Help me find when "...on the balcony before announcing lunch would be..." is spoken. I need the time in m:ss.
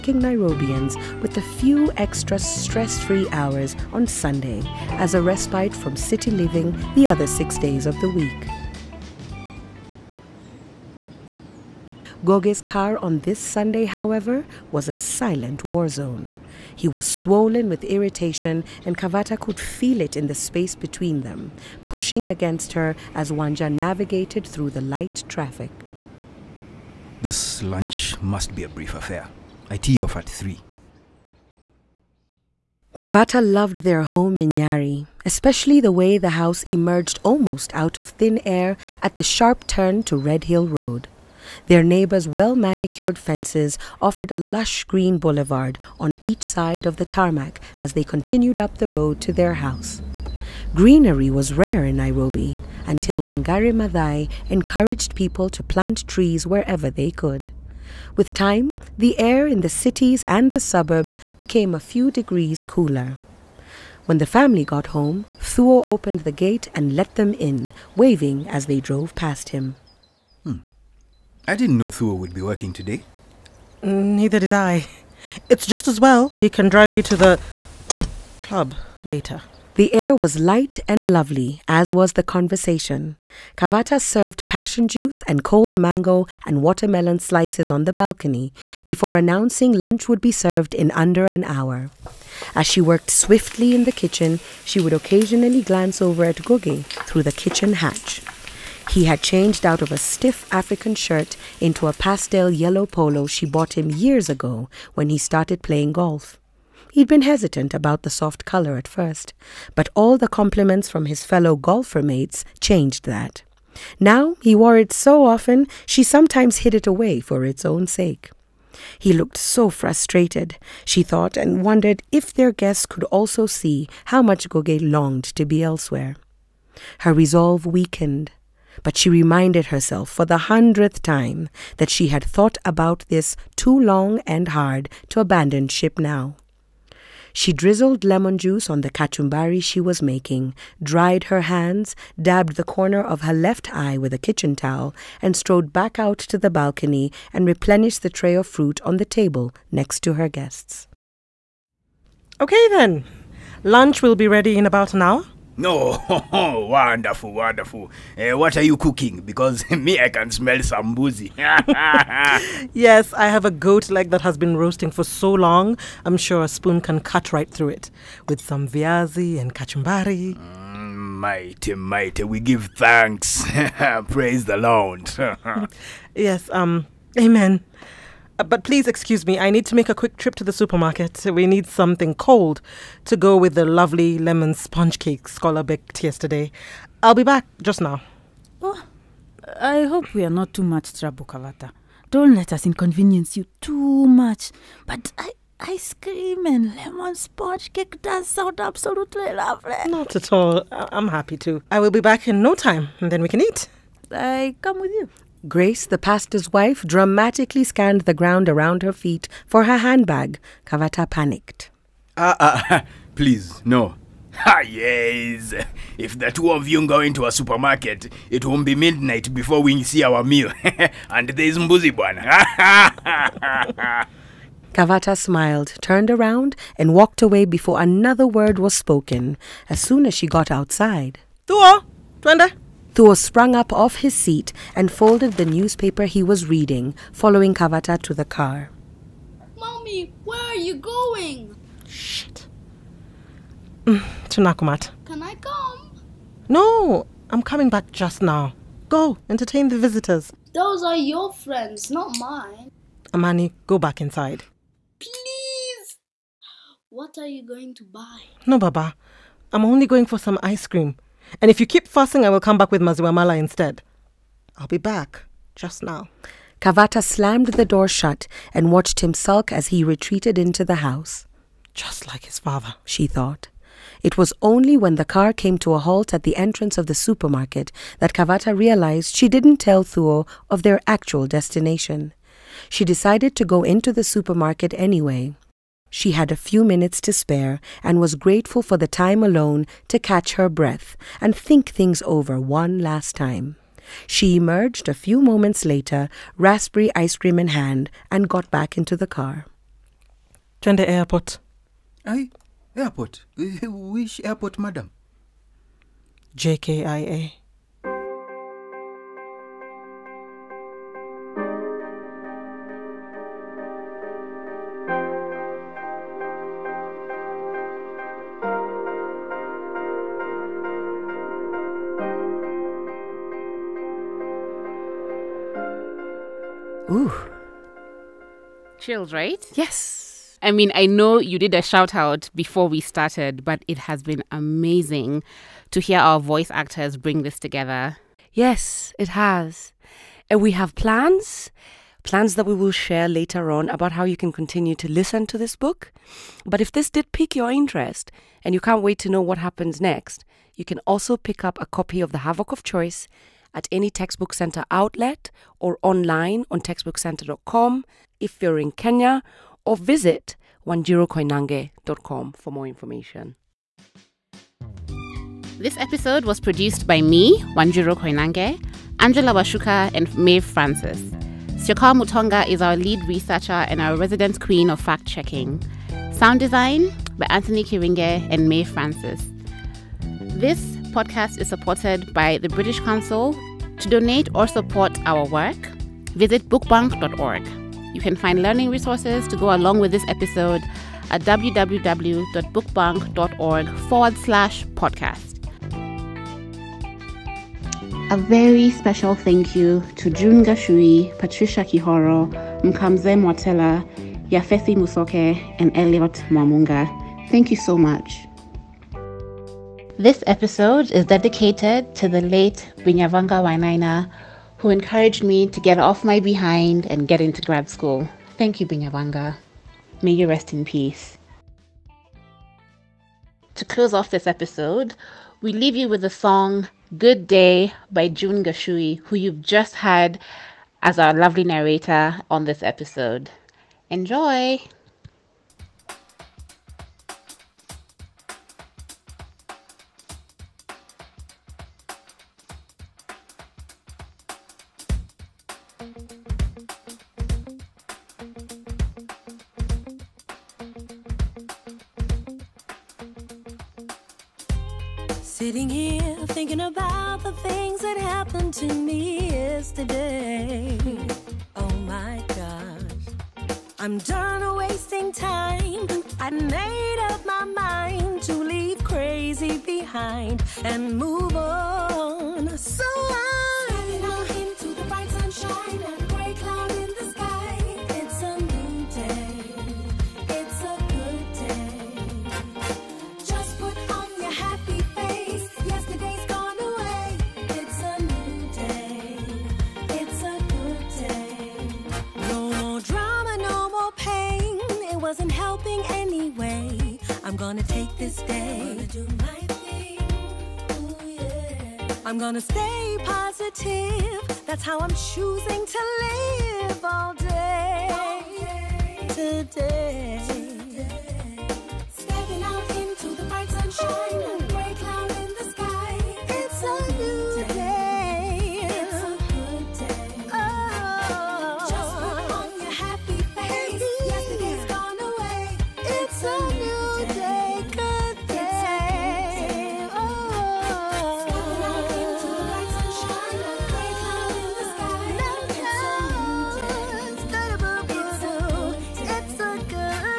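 1:27.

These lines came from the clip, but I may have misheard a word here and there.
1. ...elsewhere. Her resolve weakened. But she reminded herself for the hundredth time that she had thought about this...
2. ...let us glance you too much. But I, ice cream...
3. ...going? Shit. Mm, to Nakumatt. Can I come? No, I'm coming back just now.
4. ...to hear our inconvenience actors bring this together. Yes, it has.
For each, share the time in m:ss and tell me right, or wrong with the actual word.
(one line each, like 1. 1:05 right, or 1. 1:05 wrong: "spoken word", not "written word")
1. 2:05 right
2. 3:12 wrong: "inconvenience", not "glance"
3. 4:00 right
4. 5:35 wrong: "voice", not "inconvenience".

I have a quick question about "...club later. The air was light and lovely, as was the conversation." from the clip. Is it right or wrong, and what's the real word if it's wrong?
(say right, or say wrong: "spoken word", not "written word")
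right.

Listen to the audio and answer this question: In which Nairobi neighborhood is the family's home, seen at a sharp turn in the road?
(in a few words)
Nyari.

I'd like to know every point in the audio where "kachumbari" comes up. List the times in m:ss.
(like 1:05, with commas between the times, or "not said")
2:18, 2:49.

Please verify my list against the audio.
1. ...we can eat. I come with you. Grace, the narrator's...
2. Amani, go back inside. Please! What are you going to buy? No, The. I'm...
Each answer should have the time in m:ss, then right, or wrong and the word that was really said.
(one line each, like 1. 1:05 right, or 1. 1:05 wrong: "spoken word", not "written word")
1. 3:23 wrong: "pastor", not "narrator"
2. 4:13 wrong: "Baba", not "The".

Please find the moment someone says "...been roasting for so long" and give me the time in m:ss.
2:44.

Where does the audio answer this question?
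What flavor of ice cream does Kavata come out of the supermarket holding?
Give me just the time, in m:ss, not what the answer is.
4:56.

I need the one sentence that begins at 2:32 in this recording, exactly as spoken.
Okay then, lunch will be ready in about an hour.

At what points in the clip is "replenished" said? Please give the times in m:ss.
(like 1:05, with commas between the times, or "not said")
2:27.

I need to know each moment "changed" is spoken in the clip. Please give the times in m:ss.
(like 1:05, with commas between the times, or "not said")
1:39, 1:52.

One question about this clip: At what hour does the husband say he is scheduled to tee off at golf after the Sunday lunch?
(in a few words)
3.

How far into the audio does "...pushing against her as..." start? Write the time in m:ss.
0:21.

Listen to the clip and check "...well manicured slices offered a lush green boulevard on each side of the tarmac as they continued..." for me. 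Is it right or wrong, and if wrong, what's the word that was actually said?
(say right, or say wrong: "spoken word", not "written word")
wrong: "fences", not "slices".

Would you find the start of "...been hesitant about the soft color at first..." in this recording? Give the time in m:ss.
1:47.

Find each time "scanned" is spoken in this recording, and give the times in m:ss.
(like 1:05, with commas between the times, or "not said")
3:27.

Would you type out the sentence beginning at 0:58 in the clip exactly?
With time, the air in the cities and the suburbs became a few degrees cooler.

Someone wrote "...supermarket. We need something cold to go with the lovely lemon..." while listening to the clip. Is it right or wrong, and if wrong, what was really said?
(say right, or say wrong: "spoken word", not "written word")
right.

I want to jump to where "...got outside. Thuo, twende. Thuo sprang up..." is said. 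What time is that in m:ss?
3:50.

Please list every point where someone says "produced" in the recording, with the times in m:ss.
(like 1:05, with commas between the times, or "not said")
6:06.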